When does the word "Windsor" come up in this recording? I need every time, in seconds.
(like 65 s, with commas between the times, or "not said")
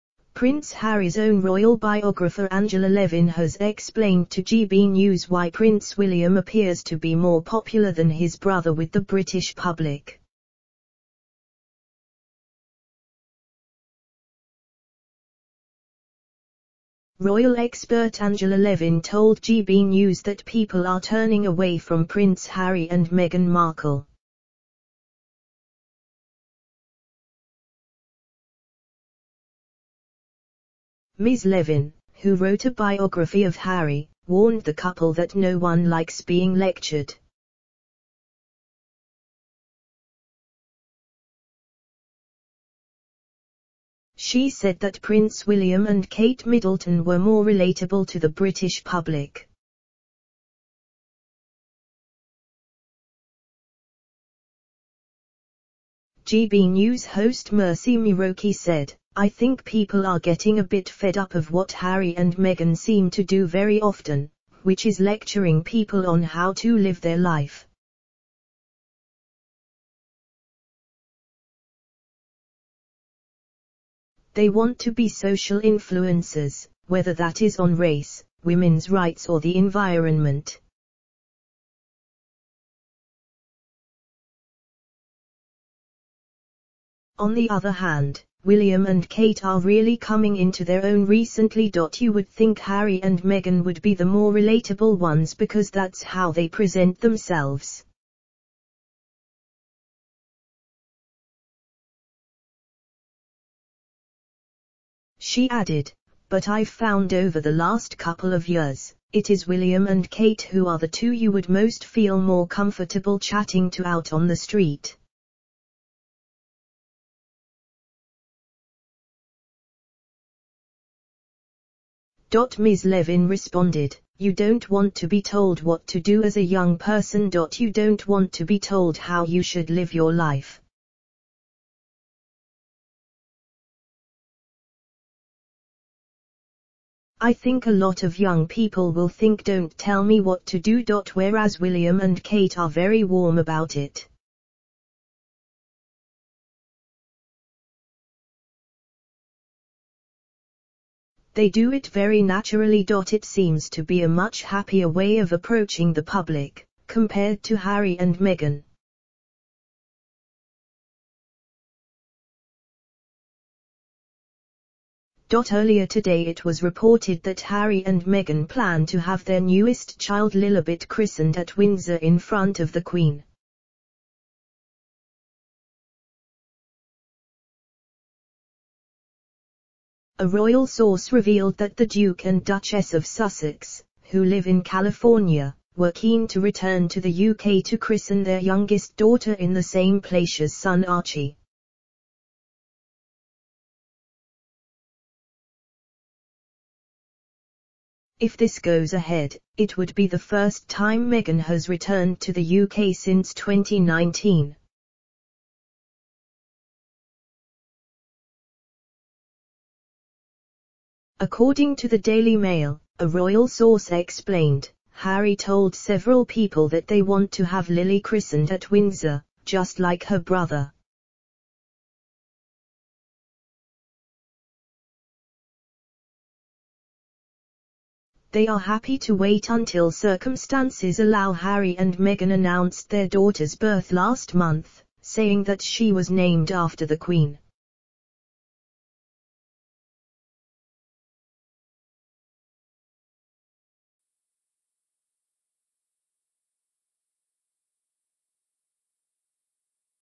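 171 s, 218 s.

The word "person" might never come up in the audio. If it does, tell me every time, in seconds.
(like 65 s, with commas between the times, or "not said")
126 s.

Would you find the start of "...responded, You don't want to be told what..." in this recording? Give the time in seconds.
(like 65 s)
123 s.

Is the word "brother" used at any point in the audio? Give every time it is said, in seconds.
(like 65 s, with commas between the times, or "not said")
8 s, 220 s.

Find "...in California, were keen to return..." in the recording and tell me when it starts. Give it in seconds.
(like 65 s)
184 s.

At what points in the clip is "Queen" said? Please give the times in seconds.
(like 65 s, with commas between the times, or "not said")
172 s, 236 s.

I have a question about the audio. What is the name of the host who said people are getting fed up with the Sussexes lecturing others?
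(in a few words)
Mercy Muroki.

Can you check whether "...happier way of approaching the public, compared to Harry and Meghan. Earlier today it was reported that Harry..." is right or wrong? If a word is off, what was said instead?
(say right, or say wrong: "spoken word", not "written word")
right.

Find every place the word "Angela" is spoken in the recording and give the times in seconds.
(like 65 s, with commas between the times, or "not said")
2 s, 18 s.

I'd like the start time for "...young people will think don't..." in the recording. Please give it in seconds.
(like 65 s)
138 s.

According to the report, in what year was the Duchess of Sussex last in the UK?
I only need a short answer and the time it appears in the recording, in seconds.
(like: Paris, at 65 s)
2019, at 203 s.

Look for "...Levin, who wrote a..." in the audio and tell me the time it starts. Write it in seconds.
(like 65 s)
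31 s.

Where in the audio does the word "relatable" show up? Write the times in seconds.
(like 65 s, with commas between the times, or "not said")
47 s, 94 s.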